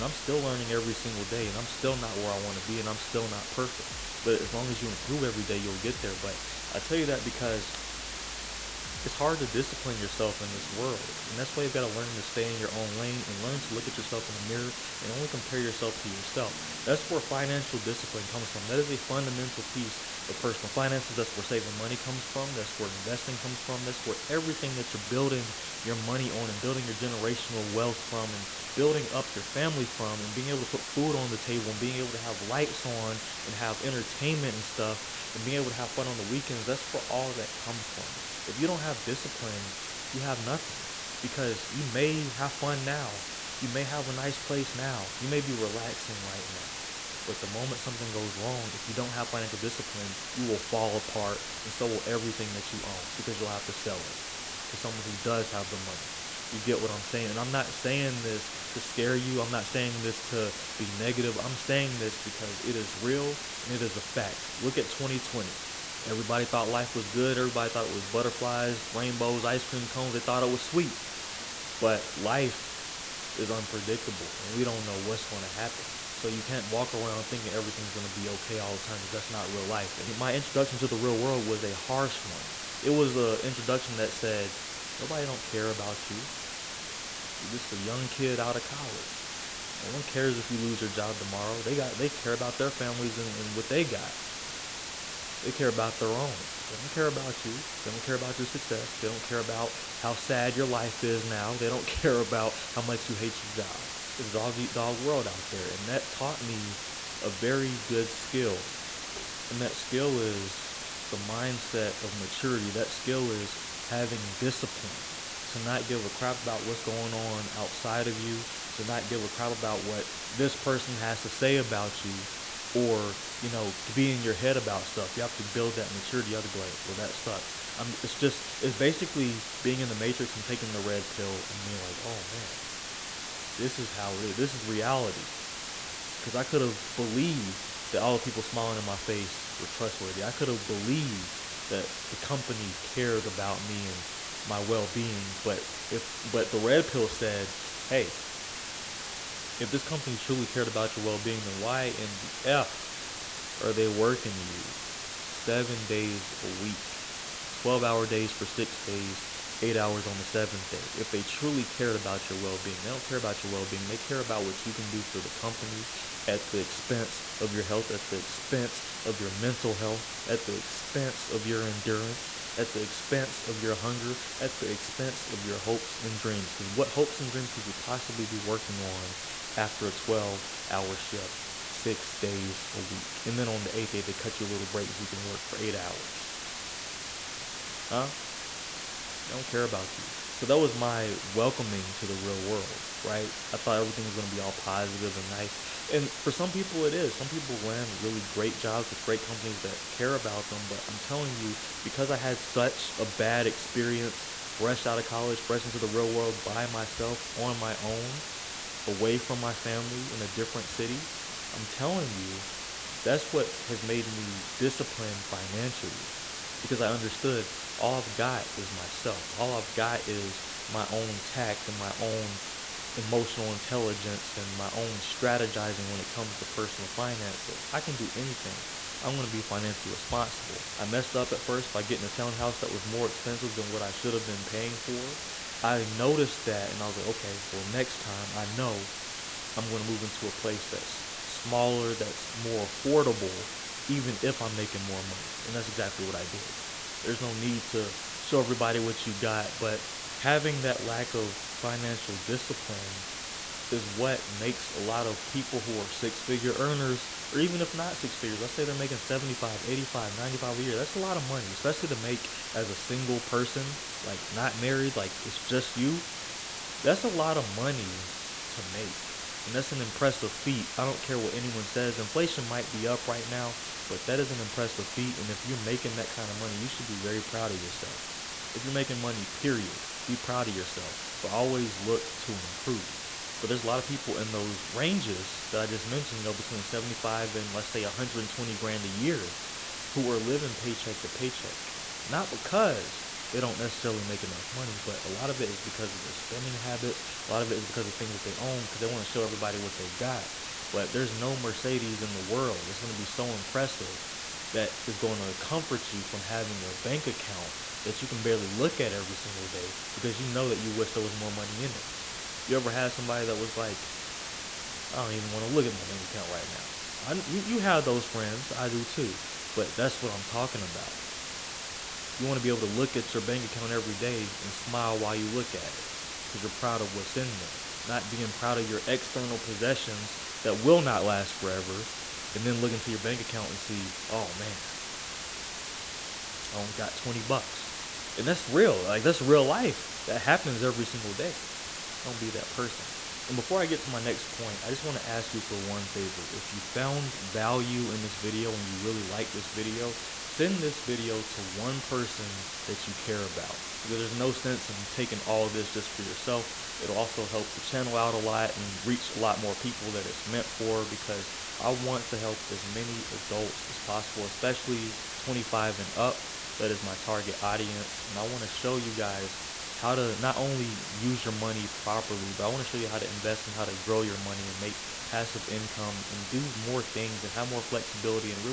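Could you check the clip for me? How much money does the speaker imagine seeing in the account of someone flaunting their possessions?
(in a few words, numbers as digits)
$20.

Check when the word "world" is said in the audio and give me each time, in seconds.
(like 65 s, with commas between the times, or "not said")
10 s, 81 s, 104 s, 192 s, 206 s, 302 s.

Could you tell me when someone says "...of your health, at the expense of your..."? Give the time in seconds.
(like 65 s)
167 s.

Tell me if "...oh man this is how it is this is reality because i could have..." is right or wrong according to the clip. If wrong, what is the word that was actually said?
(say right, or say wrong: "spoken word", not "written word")
right.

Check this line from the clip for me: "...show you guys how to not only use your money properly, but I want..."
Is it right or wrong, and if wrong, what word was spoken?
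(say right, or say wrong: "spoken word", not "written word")
right.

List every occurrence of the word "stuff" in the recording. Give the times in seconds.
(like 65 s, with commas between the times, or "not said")
34 s, 124 s.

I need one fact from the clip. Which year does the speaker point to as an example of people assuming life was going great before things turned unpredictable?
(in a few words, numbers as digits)
2020.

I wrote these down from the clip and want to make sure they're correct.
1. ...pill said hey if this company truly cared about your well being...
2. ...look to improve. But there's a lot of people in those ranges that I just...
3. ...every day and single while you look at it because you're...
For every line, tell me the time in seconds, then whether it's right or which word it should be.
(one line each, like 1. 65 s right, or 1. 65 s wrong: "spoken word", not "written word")
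1. 146 s right
2. 281 s right
3. 323 s wrong: "smile", not "single".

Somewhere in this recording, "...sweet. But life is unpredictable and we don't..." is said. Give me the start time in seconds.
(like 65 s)
70 s.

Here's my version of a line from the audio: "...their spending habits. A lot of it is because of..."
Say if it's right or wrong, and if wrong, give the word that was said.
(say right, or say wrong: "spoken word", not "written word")
right.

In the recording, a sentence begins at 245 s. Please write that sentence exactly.
And that's exactly what I did.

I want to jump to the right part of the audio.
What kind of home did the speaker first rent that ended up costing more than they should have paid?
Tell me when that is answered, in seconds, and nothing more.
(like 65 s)
232 s.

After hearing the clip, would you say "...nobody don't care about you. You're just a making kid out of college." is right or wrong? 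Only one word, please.
wrong.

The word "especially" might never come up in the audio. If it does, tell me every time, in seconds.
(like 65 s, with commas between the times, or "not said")
261 s, 364 s.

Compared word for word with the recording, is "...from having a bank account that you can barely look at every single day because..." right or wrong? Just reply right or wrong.
right.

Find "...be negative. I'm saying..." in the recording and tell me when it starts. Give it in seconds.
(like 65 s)
60 s.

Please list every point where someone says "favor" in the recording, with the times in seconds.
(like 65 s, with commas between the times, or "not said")
345 s.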